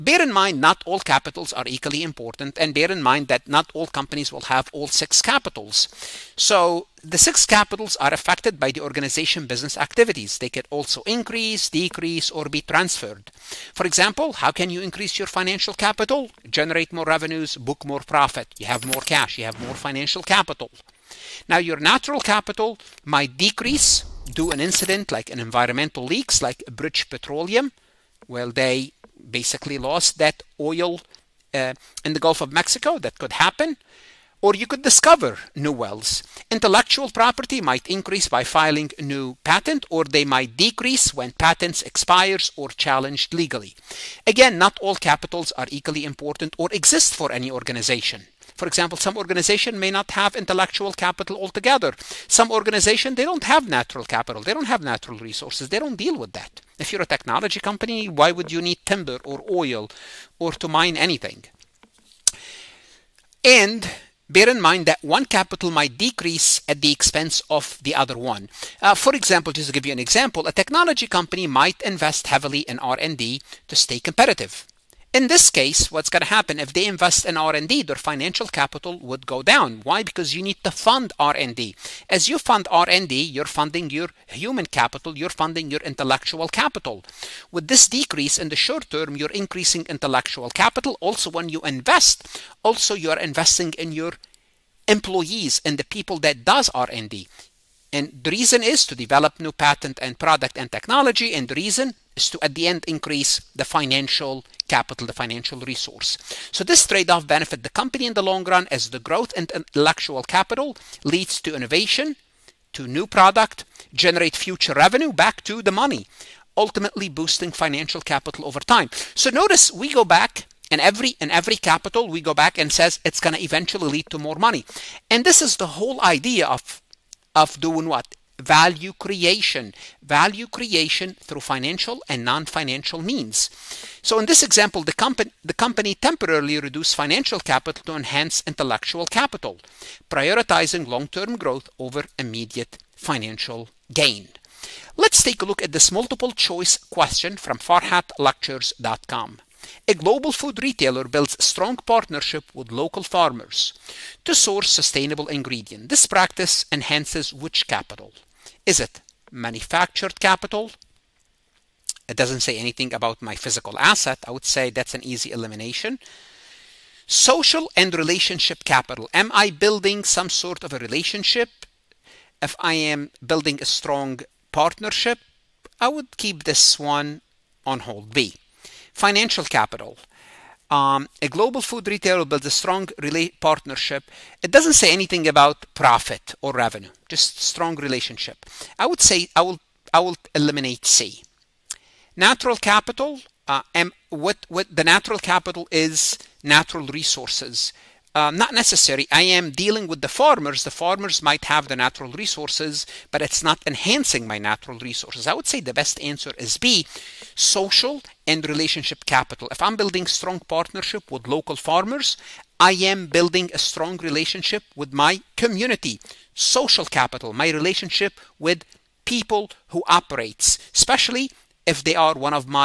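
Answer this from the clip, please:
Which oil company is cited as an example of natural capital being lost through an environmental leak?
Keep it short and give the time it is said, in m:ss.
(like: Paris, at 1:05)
British Petroleum, at 0:26.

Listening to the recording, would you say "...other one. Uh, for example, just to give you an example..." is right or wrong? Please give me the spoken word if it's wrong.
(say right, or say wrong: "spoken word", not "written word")
right.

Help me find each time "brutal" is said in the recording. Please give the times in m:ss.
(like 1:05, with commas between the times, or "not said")
not said.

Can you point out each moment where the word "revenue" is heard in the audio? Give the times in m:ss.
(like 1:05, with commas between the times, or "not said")
0:17, 1:54, 3:06.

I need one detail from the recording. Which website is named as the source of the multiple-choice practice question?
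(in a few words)
farhatlectures.com.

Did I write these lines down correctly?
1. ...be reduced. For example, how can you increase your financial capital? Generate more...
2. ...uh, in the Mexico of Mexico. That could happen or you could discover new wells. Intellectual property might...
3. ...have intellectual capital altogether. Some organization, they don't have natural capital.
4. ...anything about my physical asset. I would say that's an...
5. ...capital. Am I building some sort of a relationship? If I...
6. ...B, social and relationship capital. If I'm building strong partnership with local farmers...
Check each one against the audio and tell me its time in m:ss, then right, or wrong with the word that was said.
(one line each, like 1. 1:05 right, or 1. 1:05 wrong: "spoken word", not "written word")
1. 0:12 wrong: "transferred", not "reduced"
2. 0:31 wrong: "Gulf", not "Mexico"
3. 0:50 right
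4. 2:42 right
5. 2:48 right
6. 3:26 right.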